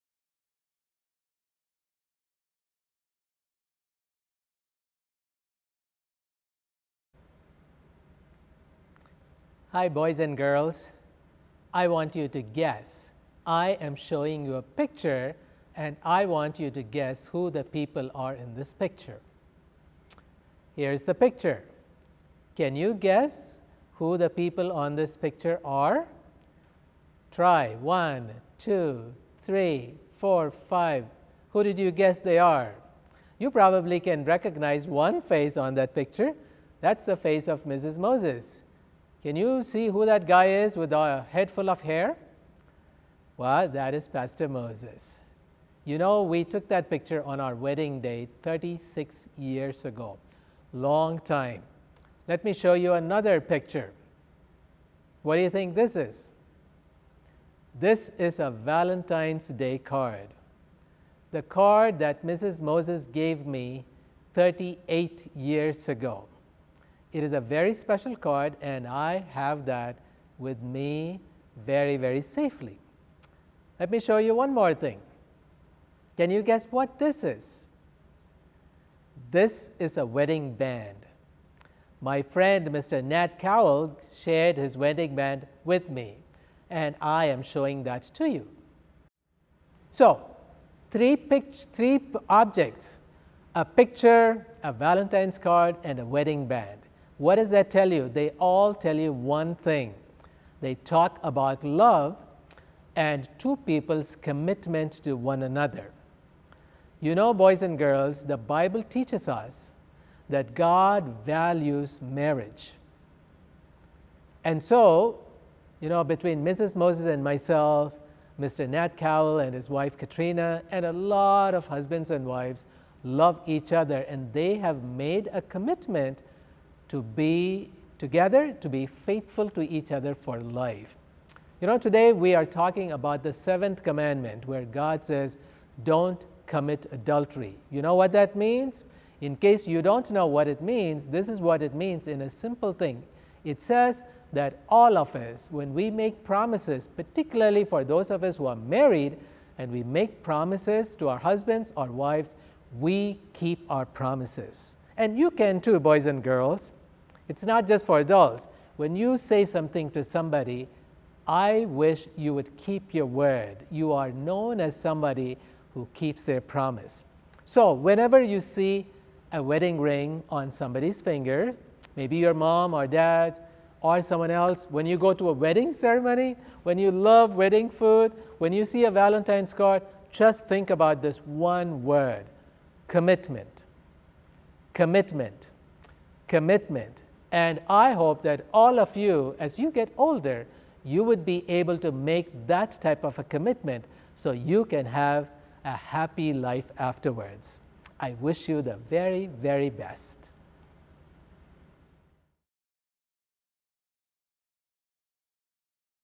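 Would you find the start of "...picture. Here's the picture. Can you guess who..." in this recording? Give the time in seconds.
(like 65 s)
18 s.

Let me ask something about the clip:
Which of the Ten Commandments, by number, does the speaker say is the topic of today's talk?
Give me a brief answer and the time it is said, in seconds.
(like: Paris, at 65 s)
seventh, at 133 s.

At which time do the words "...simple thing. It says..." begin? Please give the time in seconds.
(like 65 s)
142 s.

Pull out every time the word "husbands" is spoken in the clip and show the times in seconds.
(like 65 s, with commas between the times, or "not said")
121 s, 151 s.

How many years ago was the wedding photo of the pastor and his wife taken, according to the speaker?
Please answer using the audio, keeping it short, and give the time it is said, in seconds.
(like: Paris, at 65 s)
36, at 48 s.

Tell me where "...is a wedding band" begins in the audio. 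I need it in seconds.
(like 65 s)
79 s.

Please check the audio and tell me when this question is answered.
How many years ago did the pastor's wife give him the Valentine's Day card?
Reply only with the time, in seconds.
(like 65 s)
64 s.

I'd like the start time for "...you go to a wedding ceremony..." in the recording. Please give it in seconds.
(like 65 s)
174 s.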